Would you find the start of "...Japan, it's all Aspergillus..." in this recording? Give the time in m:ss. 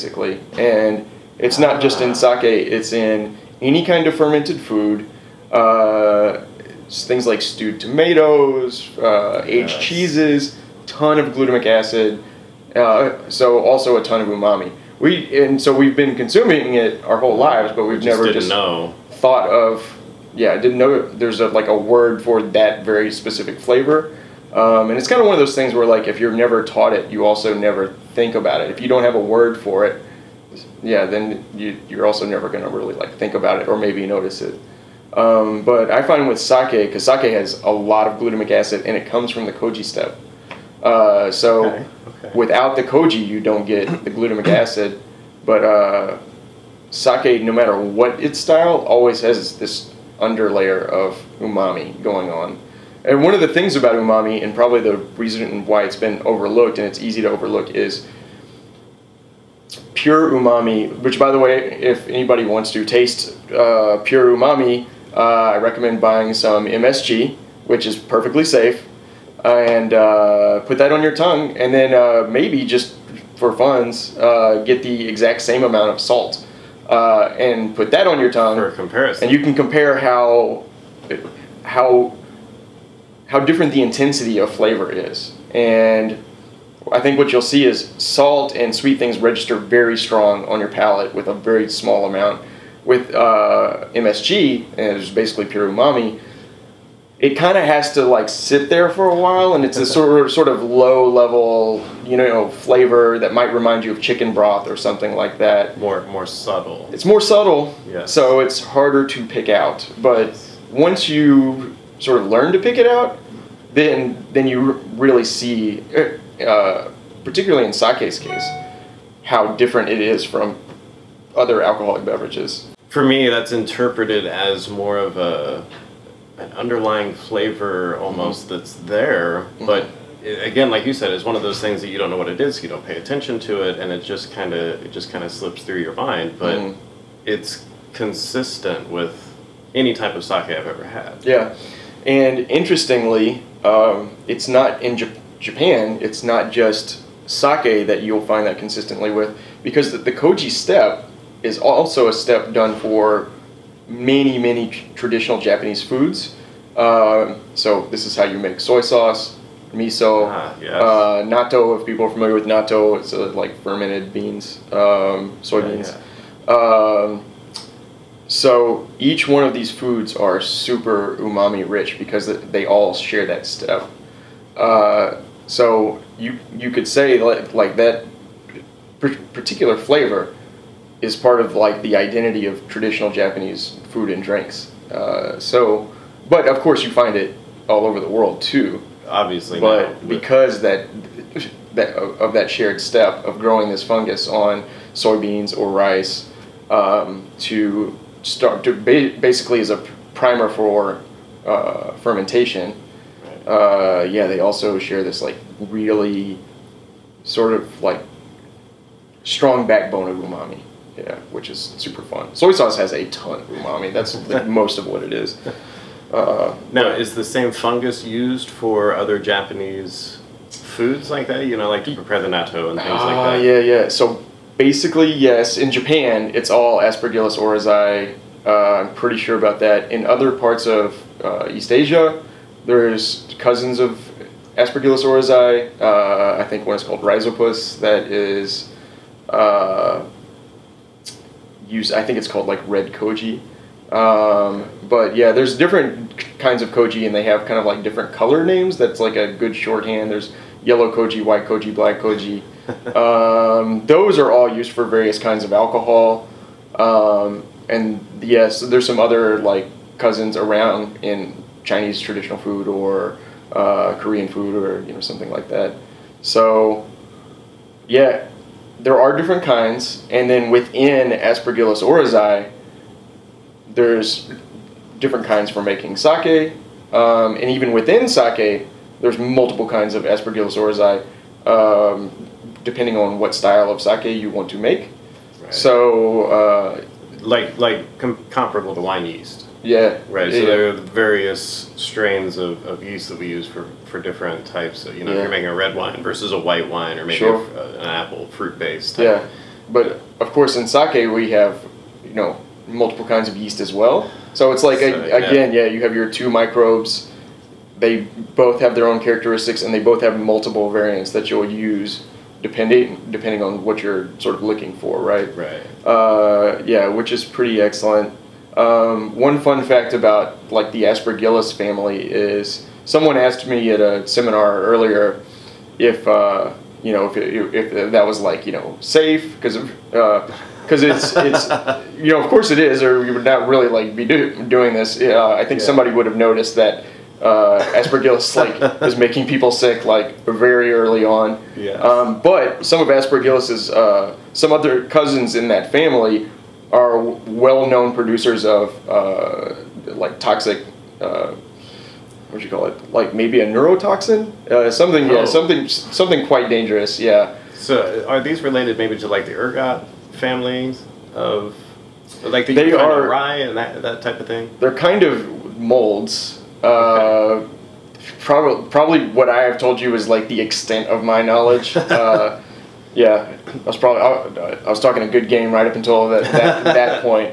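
3:45.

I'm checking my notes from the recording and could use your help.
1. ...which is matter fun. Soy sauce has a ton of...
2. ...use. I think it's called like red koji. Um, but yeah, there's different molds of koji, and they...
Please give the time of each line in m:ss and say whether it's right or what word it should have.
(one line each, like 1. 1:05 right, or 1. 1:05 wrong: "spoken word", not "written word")
1. 3:31 wrong: "super", not "matter"
2. 4:01 wrong: "kinds", not "molds".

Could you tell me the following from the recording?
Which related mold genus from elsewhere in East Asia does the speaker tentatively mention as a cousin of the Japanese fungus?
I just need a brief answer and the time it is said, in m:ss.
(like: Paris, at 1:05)
Rhizopus, at 3:56.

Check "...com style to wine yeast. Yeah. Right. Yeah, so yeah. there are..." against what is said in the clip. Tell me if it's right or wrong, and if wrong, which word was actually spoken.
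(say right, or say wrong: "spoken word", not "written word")
wrong: "comparable", not "style".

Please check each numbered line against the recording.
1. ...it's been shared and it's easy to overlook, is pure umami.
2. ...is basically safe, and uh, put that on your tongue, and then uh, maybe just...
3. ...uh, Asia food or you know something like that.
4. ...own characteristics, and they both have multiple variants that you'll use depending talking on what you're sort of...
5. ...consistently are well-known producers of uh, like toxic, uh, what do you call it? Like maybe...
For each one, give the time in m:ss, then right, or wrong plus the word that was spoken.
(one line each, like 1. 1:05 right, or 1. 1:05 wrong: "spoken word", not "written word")
1. 0:55 wrong: "overlooked", not "shared"
2. 1:07 wrong: "perfectly", not "basically"
3. 4:23 wrong: "Korean", not "Asia"
4. 5:08 wrong: "depending", not "talking"
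5. 5:45 wrong: "family", not "consistently".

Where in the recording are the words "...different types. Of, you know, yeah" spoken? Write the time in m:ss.
4:53.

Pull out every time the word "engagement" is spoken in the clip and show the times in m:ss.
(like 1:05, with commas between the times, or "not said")
not said.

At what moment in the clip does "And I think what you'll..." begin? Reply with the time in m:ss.
1:25.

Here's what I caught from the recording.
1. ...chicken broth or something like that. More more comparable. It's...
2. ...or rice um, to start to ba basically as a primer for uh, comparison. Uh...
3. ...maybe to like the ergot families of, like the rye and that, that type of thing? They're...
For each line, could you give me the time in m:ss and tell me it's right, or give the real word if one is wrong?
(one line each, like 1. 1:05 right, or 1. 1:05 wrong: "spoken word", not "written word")
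1. 1:44 wrong: "subtle", not "comparable"
2. 3:15 wrong: "fermentation", not "comparison"
3. 5:58 right.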